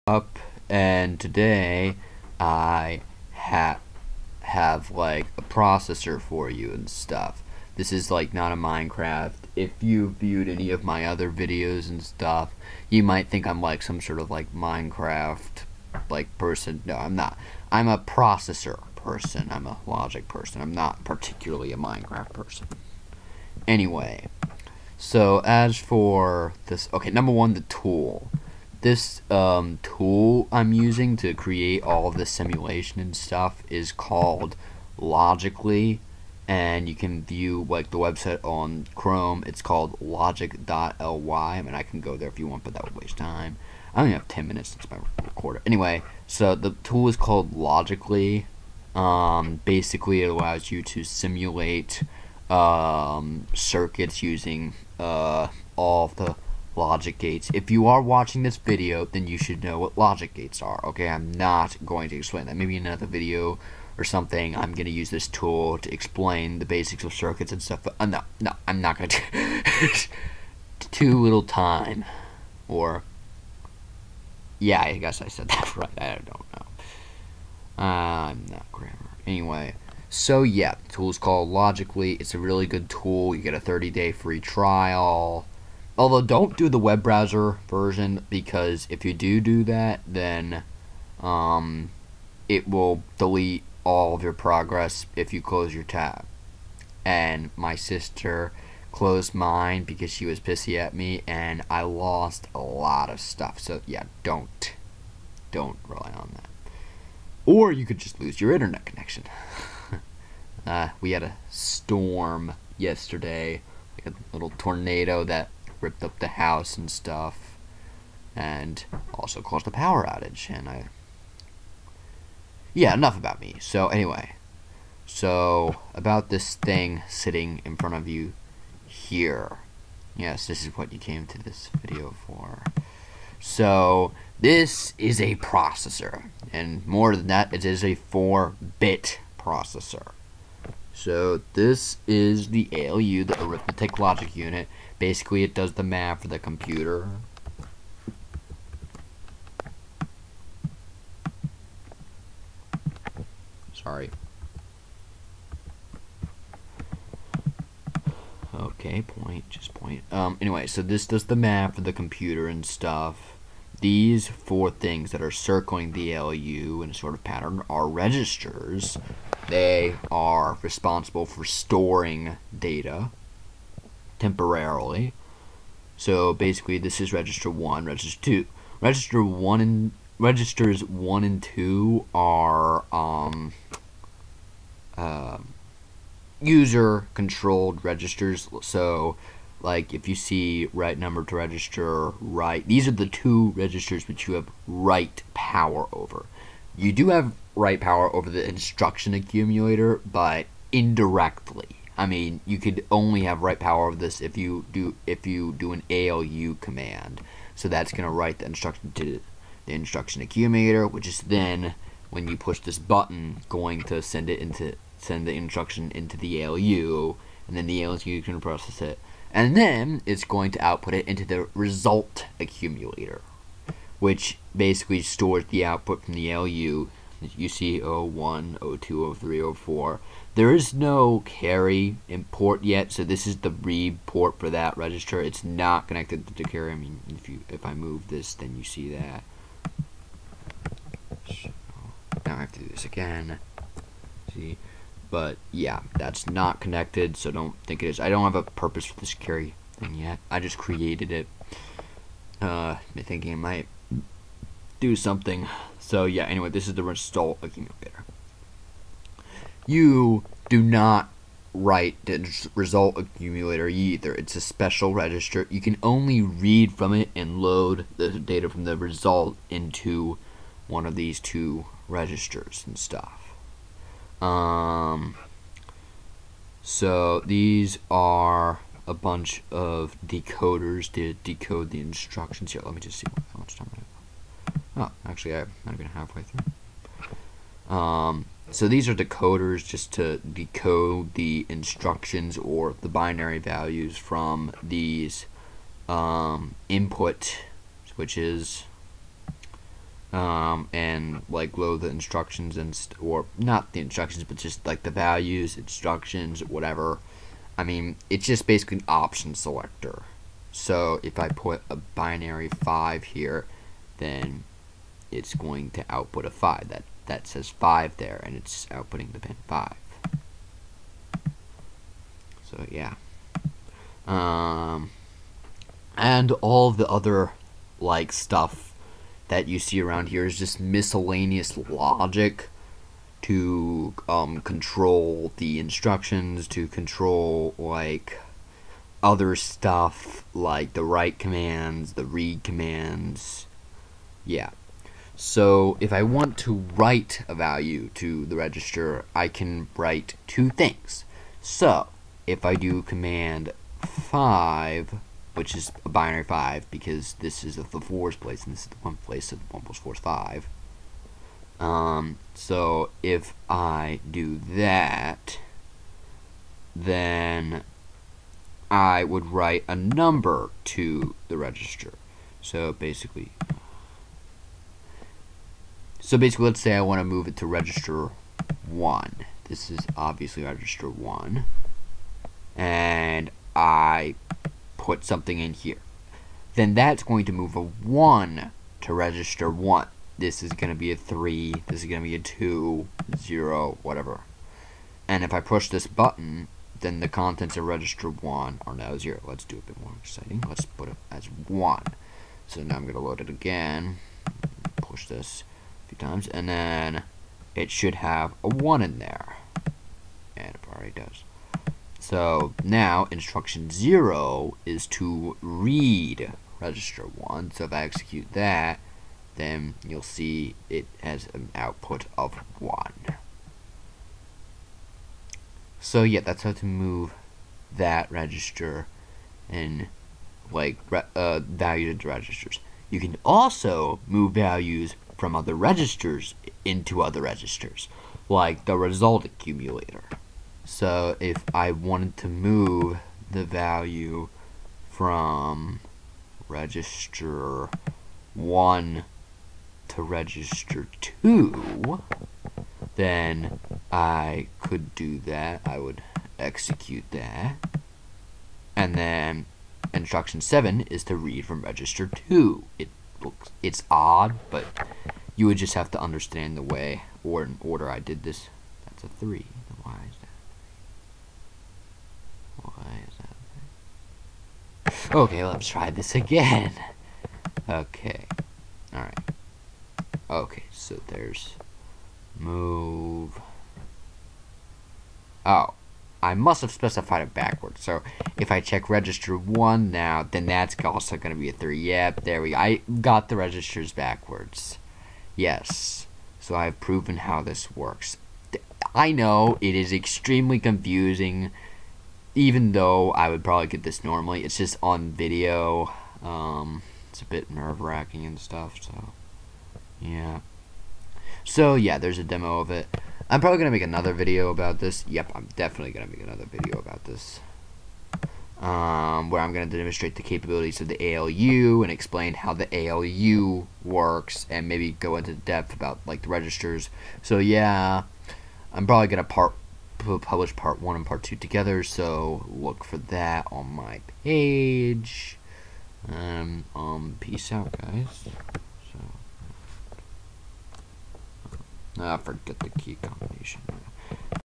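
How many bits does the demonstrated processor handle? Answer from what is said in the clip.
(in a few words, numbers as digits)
4.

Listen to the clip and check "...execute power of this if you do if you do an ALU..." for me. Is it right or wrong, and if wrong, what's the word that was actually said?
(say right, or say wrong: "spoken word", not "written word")
wrong: "write", not "execute".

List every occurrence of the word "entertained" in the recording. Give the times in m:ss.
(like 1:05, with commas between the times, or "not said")
not said.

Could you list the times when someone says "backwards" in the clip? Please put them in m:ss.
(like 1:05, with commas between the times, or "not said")
8:07, 8:13.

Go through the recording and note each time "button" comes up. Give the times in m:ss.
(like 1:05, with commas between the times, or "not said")
3:32, 6:35.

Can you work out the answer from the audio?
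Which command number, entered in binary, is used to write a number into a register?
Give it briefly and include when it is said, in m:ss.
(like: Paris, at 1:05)
5, at 5:52.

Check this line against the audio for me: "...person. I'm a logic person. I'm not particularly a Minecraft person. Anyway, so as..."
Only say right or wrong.
right.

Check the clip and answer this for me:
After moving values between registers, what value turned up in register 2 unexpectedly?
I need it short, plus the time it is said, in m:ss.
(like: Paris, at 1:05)
3, at 7:48.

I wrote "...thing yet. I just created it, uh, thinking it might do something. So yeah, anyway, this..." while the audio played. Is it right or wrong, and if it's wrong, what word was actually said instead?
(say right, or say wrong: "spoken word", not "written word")
right.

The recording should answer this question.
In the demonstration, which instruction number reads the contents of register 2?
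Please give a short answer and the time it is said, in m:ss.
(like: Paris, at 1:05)
7, at 7:39.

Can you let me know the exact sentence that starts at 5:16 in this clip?
That that says 5 there, and it's outputting the pin 5.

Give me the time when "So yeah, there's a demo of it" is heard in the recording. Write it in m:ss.
8:31.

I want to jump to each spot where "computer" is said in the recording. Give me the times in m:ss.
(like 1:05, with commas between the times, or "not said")
2:26, 2:41.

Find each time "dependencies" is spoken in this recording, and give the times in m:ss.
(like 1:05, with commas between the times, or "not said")
not said.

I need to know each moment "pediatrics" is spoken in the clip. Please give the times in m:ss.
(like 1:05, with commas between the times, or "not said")
not said.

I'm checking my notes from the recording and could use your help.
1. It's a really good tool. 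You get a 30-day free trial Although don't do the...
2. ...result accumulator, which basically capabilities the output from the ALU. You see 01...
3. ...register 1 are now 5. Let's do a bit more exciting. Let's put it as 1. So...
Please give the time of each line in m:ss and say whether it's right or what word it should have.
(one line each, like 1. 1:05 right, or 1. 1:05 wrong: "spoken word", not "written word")
1. 1:22 right
2. 3:41 wrong: "stores", not "capabilities"
3. 6:37 wrong: "0", not "5".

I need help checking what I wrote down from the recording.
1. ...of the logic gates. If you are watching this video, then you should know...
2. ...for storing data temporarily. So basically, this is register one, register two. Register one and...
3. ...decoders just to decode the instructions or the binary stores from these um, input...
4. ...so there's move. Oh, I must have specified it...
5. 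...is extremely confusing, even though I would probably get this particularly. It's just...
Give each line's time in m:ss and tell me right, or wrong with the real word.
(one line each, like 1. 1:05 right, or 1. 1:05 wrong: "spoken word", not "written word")
1. 0:56 right
2. 2:51 right
3. 4:48 wrong: "values", not "stores"
4. 8:00 right
5. 8:19 wrong: "normally", not "particularly".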